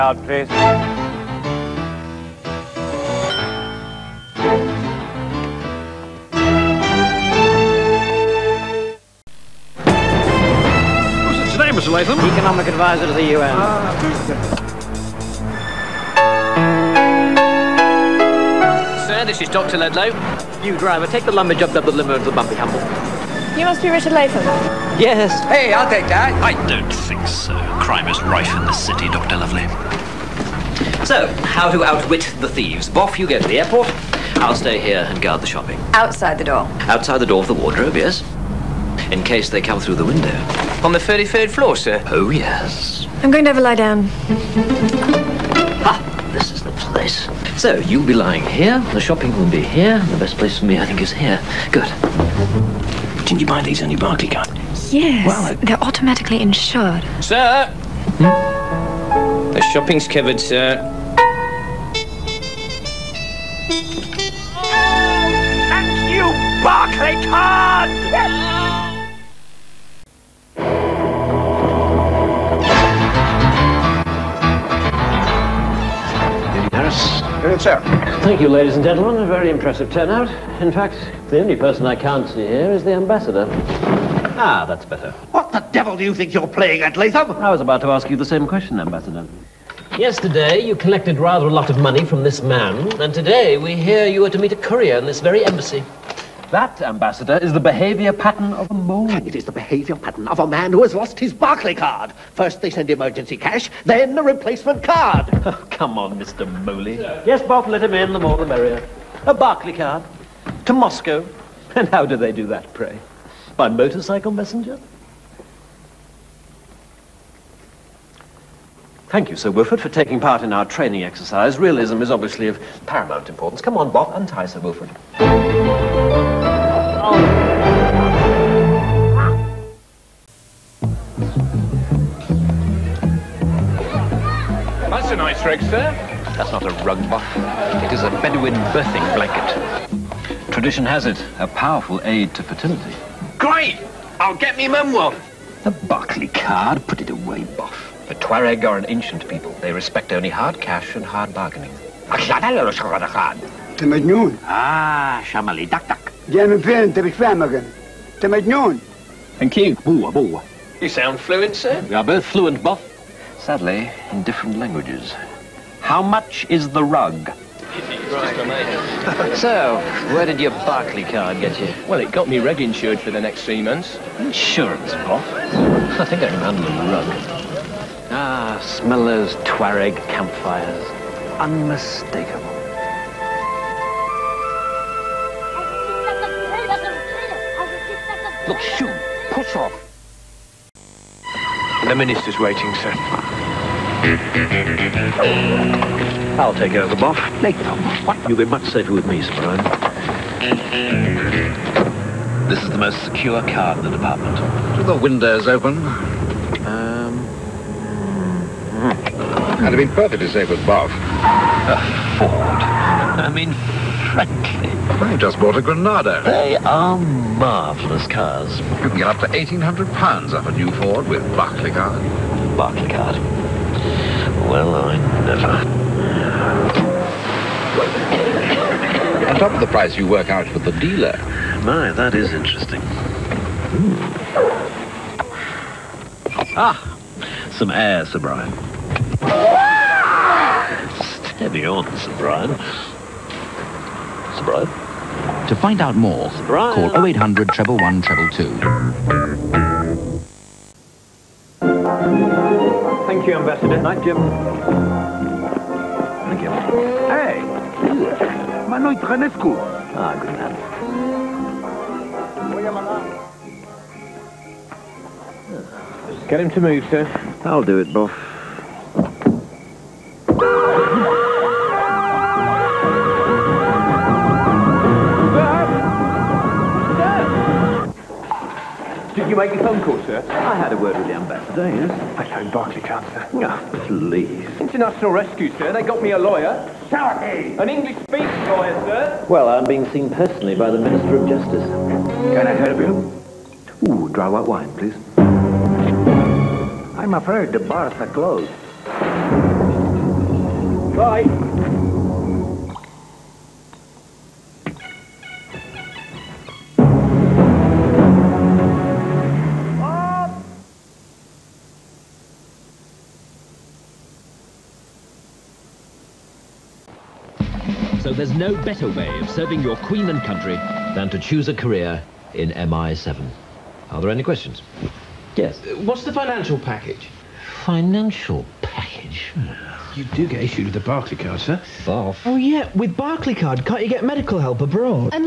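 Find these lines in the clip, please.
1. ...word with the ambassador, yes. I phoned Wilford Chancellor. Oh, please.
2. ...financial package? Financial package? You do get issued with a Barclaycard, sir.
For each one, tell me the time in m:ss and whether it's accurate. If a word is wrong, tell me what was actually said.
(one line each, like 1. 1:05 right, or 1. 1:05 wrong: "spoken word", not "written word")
1. 4:40 wrong: "Barclay", not "Wilford"
2. 5:26 right.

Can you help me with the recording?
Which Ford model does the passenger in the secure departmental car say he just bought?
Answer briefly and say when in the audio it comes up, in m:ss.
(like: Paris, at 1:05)
Granada, at 3:35.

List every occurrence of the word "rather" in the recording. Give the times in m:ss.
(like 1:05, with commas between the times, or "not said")
1:31.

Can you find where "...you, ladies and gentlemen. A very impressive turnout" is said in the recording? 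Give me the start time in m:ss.
1:18.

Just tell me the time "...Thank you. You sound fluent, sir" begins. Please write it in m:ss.
2:39.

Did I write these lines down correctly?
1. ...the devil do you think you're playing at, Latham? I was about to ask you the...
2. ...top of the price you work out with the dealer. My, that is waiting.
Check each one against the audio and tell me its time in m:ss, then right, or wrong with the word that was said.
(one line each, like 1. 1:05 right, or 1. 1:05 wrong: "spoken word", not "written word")
1. 1:25 right
2. 3:49 wrong: "interesting", not "waiting".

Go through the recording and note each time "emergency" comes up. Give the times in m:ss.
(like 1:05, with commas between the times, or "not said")
1:42.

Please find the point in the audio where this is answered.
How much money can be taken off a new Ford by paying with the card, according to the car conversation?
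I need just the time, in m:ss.
3:39.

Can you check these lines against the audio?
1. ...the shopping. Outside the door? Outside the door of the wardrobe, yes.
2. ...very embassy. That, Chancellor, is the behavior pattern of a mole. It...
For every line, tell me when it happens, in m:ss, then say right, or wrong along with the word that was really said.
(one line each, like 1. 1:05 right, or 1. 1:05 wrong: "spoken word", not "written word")
1. 0:35 right
2. 1:35 wrong: "Ambassador", not "Chancellor".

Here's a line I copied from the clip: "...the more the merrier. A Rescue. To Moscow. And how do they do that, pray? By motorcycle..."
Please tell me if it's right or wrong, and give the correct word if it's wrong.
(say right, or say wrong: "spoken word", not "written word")
wrong: "Barclaycard", not "Rescue".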